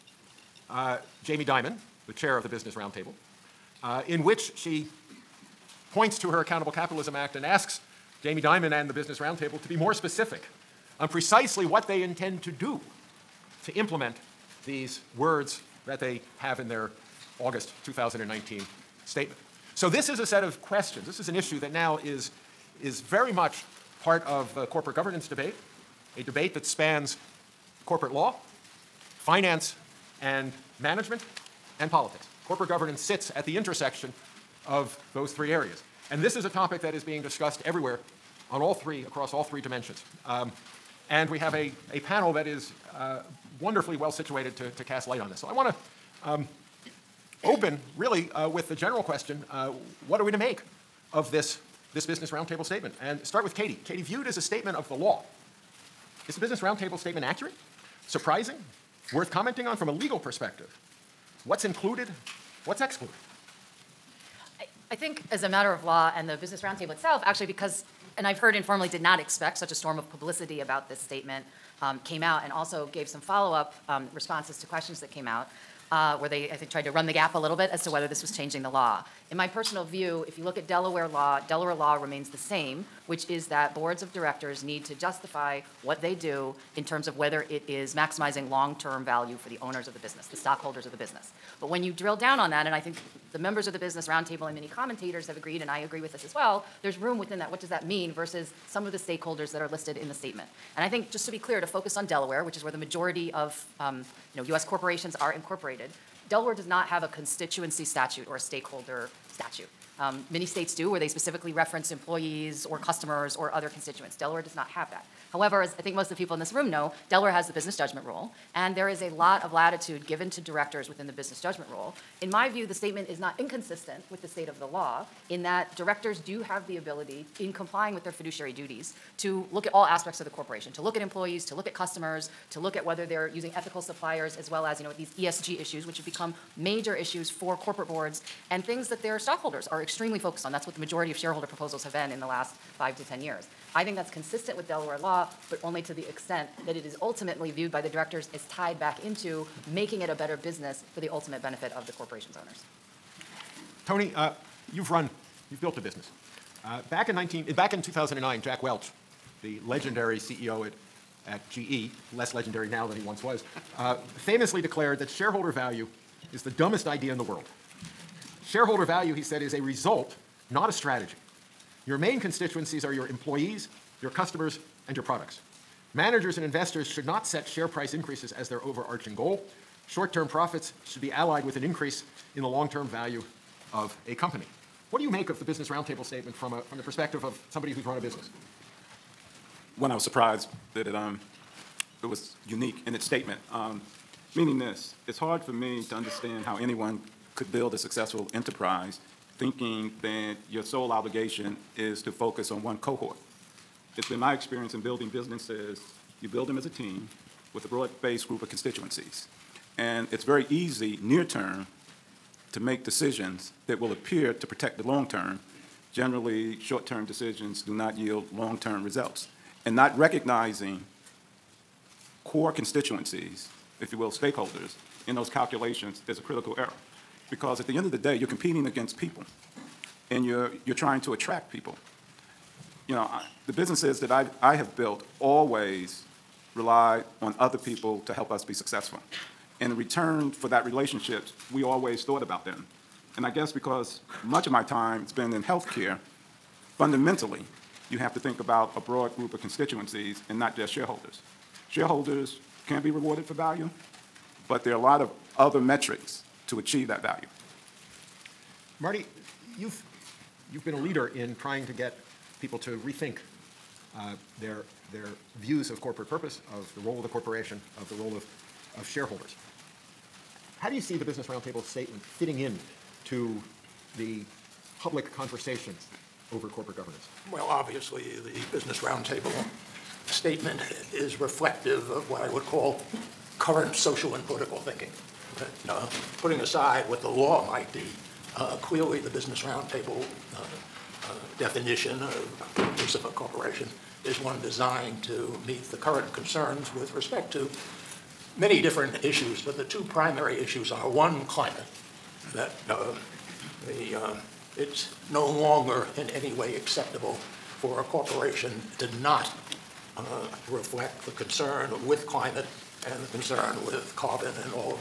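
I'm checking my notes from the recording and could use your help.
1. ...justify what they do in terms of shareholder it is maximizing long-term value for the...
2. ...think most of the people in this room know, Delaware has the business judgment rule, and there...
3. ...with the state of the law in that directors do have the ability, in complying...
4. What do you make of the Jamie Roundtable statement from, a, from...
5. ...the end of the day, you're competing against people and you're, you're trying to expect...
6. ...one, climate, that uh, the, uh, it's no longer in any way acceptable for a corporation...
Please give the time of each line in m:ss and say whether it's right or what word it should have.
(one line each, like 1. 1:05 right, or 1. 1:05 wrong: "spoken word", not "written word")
1. 1:24 wrong: "whether", not "shareholder"
2. 1:55 right
3. 2:04 right
4. 3:04 wrong: "Business", not "Jamie"
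5. 3:47 wrong: "attract", not "expect"
6. 5:00 right.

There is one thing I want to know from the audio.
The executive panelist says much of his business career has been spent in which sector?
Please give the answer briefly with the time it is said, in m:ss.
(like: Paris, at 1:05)
healthcare, at 4:05.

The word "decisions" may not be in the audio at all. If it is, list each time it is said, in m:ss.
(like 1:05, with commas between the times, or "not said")
3:32, 3:37.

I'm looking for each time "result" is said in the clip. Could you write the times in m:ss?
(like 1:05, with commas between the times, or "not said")
2:49, 3:38.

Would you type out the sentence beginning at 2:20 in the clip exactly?
That's what the majority of shareholder proposals have been in the last five to 10 years.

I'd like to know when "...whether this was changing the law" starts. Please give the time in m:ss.
1:17.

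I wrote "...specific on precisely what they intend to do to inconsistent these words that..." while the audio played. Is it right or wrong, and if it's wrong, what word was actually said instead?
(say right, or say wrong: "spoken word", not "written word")
wrong: "implement", not "inconsistent".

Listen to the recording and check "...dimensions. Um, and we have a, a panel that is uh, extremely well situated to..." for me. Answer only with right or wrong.
wrong.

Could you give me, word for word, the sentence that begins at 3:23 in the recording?
It's been my experience in building businesses, you build them as a team with a broad-based group of constituencies.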